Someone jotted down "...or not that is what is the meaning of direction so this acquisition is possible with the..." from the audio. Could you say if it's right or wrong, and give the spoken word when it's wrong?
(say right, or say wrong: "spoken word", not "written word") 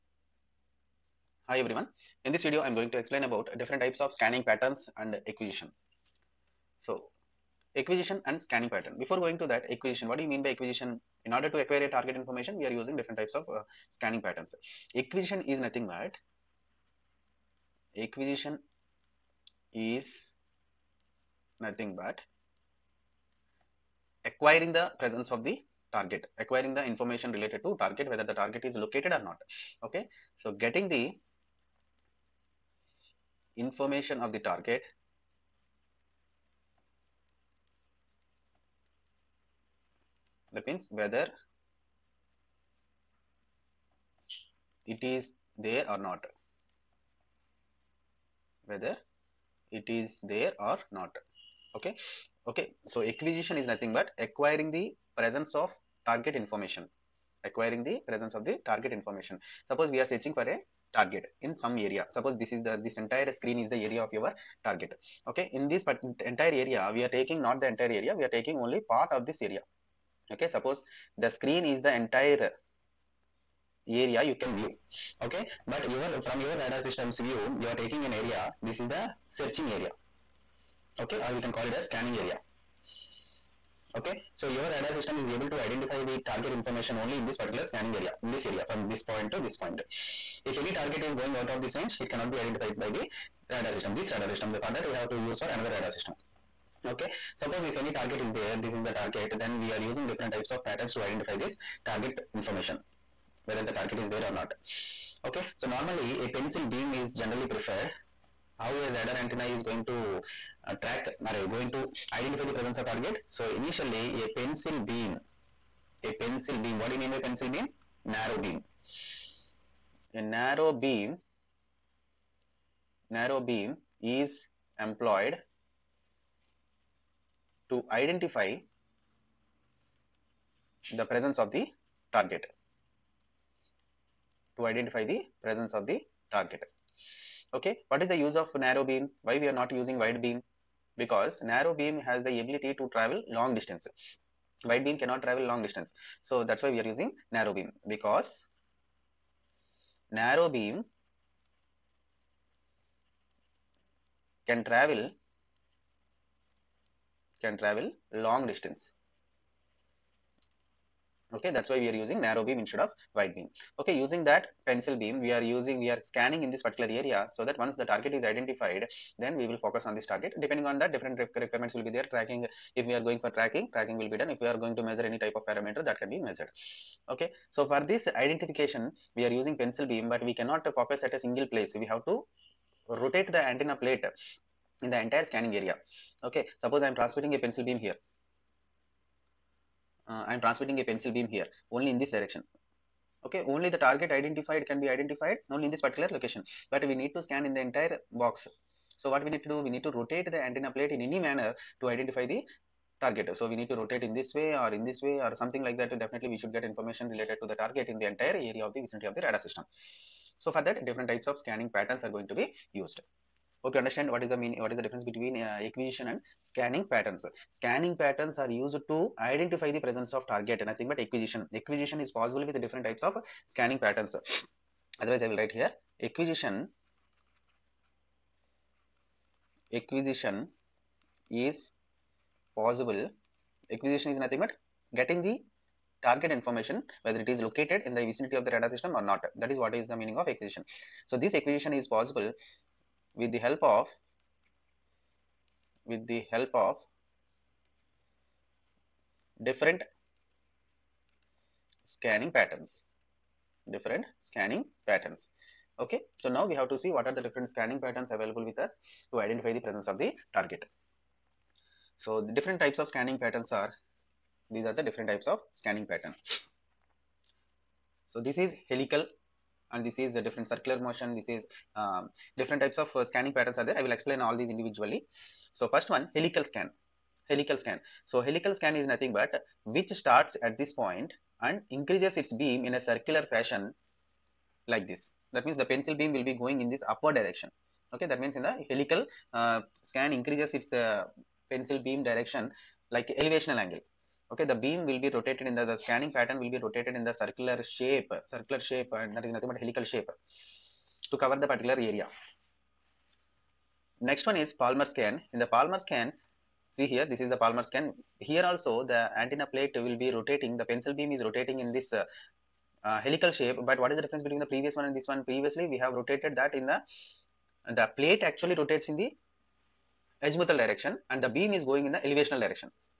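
wrong: "acquisition", not "direction".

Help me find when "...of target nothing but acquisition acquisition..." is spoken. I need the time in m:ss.
3:40.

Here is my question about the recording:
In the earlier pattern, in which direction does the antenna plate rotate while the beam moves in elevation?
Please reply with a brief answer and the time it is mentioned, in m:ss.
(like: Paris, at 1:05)
azimuthal, at 5:20.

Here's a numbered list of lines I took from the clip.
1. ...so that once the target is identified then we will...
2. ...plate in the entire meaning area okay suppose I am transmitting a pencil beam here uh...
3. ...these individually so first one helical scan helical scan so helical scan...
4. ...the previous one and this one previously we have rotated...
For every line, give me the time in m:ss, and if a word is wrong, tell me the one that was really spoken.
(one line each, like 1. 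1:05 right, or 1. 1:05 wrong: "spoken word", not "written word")
1. 2:47 right
2. 3:03 wrong: "scanning", not "meaning"
3. 4:34 right
4. 5:14 right.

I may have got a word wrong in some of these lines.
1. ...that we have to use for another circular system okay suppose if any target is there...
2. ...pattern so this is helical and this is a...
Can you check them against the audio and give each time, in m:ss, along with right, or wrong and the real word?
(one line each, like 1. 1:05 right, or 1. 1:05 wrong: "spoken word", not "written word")
1. 1:34 wrong: "radar", not "circular"
2. 4:25 right.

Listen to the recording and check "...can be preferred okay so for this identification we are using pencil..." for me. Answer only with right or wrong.
wrong.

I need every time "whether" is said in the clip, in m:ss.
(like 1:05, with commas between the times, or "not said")
0:28, 0:40, 0:48, 1:43, 3:57.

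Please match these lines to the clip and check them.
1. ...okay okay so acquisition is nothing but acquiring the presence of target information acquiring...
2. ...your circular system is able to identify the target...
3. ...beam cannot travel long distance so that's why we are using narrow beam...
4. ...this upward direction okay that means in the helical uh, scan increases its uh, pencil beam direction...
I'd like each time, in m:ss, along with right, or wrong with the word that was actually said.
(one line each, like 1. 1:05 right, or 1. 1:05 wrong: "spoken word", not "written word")
1. 0:51 right
2. 1:24 wrong: "radar", not "circular"
3. 2:24 right
4. 4:46 right.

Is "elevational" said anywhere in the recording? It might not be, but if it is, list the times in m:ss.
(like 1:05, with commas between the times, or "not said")
4:53, 5:22.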